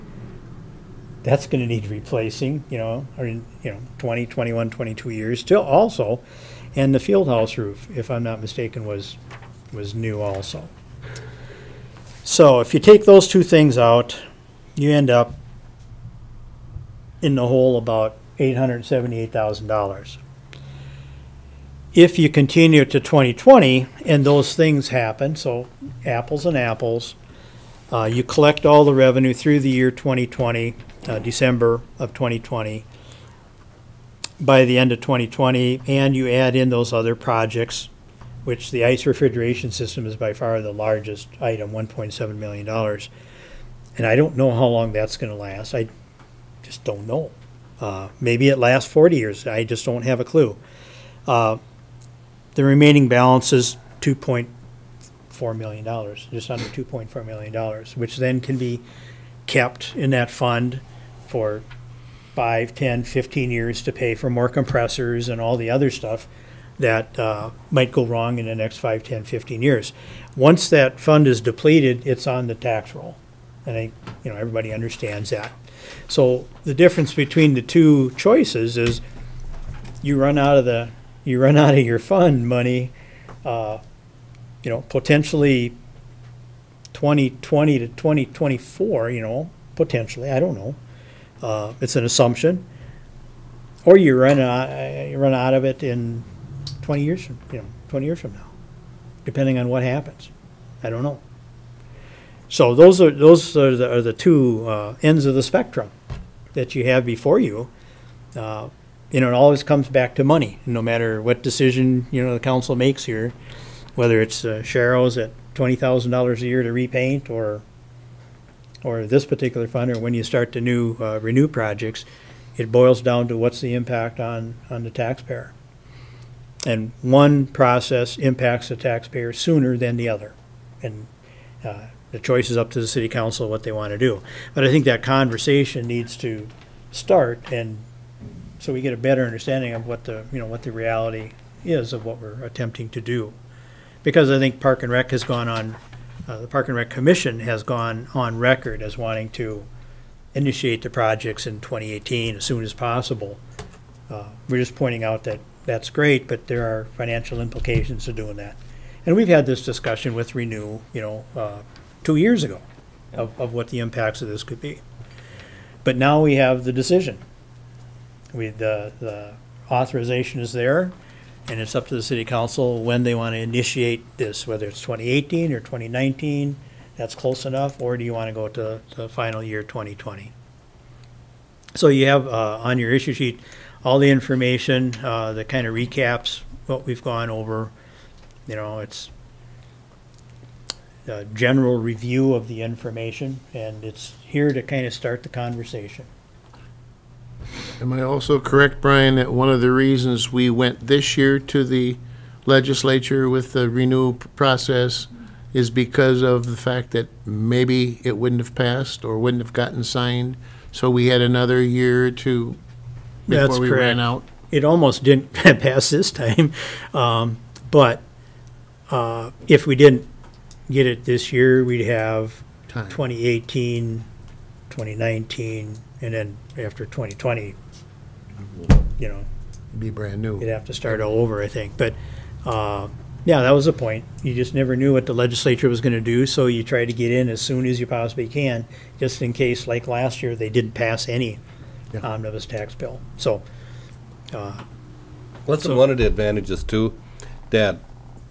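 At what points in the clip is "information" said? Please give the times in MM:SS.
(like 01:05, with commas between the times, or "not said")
03:04, 03:12.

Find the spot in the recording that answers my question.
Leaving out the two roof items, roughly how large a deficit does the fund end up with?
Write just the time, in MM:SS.
00:18.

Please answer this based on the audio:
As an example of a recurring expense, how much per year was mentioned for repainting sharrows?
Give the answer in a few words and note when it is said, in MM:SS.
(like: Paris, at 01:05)
$20,000, at 01:55.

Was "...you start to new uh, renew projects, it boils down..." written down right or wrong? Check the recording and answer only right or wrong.
right.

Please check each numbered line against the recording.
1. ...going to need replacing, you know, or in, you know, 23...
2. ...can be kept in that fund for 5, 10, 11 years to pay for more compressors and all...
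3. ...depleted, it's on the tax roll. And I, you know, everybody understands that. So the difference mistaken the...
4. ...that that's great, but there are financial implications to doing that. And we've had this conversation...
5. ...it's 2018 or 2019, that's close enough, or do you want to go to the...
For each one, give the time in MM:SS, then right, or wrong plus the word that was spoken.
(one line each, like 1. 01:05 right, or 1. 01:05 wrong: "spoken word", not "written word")
1. 00:01 wrong: "20", not "23"
2. 00:58 wrong: "15", not "11"
3. 01:11 wrong: "between", not "mistaken"
4. 02:35 wrong: "discussion", not "conversation"
5. 02:54 right.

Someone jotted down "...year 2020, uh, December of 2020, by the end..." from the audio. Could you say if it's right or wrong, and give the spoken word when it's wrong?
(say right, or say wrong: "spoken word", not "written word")
right.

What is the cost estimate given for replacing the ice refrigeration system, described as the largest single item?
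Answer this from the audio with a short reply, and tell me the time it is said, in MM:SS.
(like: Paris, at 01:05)
$1.7 million, at 00:41.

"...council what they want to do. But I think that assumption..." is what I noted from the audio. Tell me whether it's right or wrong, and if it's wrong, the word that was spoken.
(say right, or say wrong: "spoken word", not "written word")
wrong: "conversation", not "assumption".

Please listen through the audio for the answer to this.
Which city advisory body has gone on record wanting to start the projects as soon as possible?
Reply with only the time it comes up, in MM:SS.
02:26.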